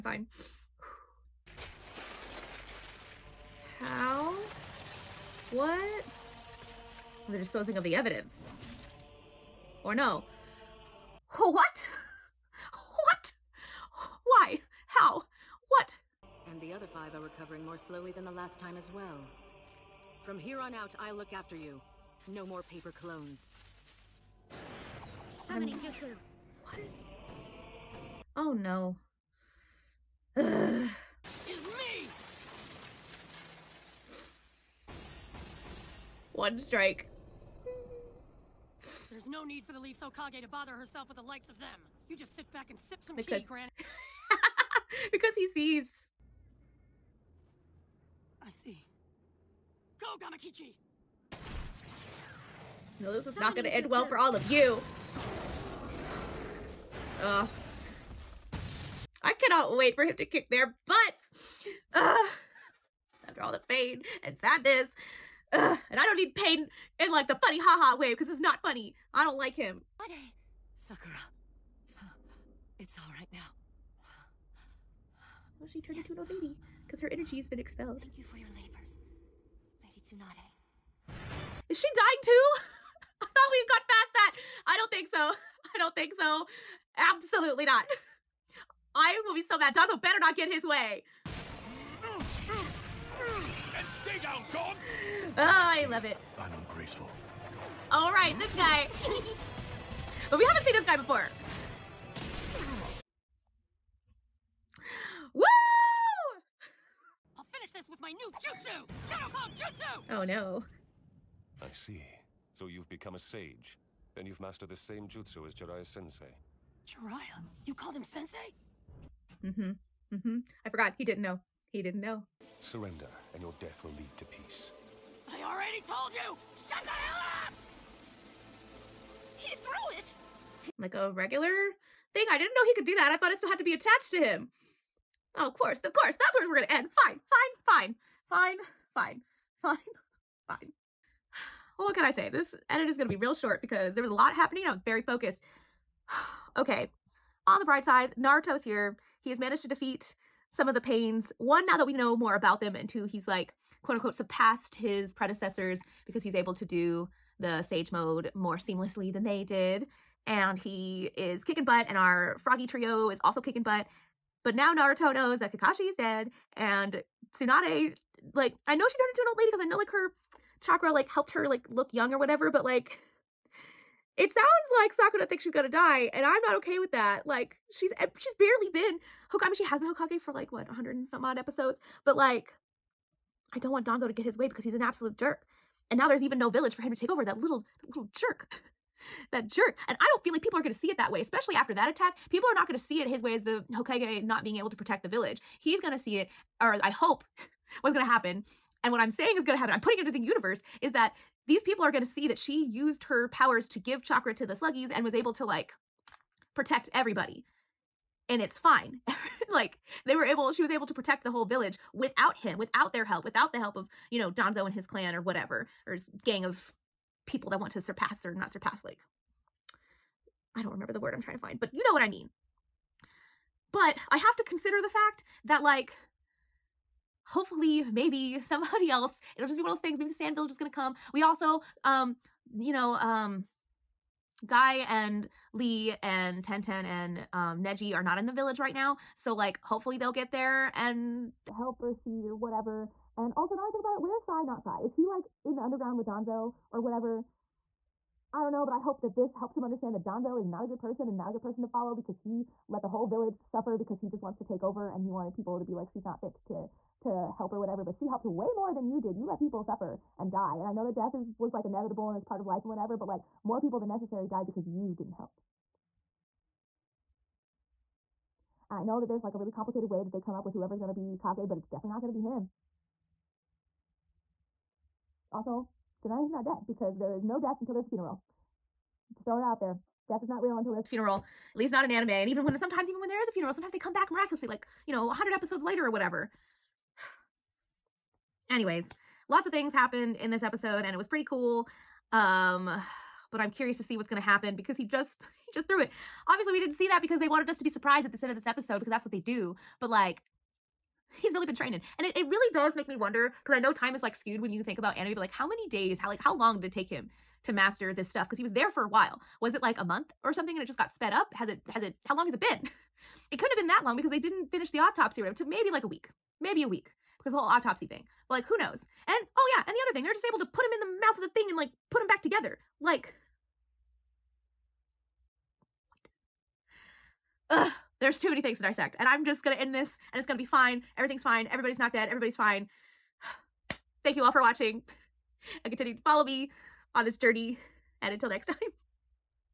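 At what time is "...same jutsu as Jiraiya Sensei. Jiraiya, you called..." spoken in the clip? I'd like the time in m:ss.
1:54.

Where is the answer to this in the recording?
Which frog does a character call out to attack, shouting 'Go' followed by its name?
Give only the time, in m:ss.
0:50.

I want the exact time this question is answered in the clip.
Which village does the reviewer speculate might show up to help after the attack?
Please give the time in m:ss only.
3:50.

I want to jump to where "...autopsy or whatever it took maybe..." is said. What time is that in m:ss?
5:14.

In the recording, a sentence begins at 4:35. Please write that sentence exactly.
Also, Tsunade's not dead because there is no death until there's a funeral.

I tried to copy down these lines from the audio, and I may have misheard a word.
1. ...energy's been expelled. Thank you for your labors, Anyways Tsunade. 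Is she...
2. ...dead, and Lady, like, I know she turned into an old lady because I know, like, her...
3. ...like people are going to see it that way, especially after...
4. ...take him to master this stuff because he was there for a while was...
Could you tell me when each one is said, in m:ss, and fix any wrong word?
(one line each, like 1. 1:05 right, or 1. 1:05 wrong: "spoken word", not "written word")
1. 1:17 wrong: "Lady", not "Anyways"
2. 2:45 wrong: "Tsunade", not "Lady"
3. 3:10 right
4. 5:06 right.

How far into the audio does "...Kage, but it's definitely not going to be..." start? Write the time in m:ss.
4:31.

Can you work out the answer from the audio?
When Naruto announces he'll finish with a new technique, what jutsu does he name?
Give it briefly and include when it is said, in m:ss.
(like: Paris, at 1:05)
Shadow Clone Jutsu, at 1:49.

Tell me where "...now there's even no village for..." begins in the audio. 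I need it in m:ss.
3:05.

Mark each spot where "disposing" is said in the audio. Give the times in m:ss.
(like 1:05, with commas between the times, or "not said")
0:07.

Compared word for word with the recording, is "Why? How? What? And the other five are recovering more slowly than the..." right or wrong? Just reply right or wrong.
right.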